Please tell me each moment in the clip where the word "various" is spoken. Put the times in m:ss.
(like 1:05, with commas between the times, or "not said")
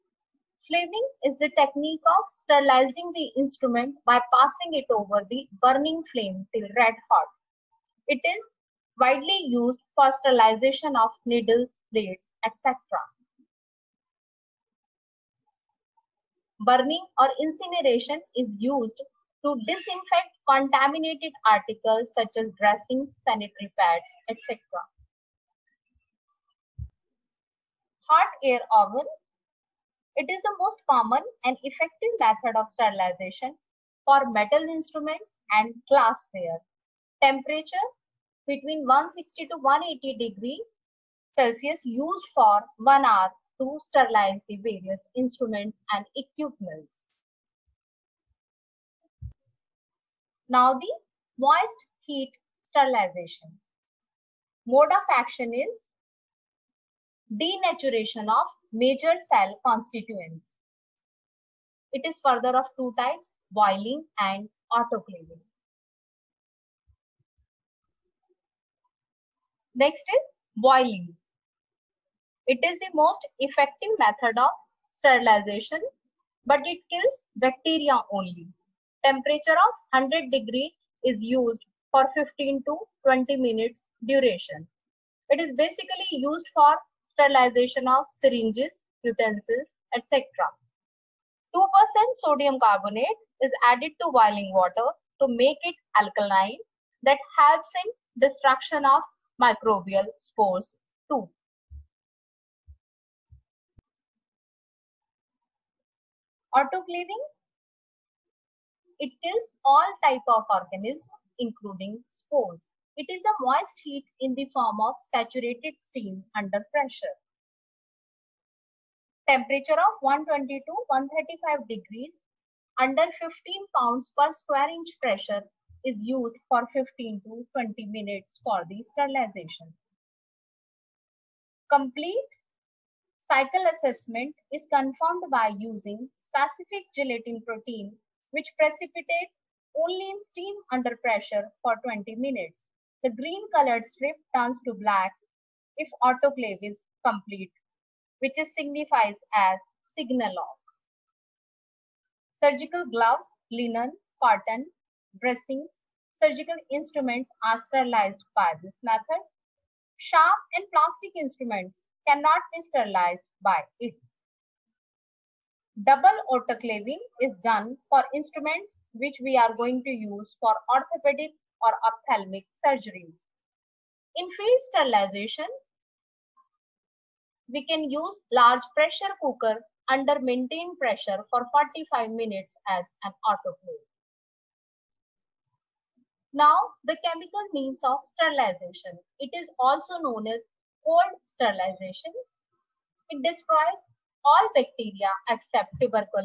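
0:44.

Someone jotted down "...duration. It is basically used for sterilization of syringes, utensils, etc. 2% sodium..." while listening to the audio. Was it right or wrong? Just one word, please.
right.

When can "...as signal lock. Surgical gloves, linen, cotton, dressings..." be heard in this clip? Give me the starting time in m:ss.
2:29.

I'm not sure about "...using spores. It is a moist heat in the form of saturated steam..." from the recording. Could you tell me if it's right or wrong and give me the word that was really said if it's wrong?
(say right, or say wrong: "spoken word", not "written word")
wrong: "including", not "using".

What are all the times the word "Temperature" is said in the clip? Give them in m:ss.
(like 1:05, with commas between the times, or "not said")
0:37, 1:19, 1:59.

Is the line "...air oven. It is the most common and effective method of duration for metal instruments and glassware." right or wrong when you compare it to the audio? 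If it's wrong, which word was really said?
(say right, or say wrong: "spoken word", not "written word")
wrong: "sterilization", not "duration".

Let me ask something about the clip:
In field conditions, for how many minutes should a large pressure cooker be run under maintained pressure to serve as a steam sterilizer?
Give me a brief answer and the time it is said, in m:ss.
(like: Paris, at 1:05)
45 minutes, at 3:01.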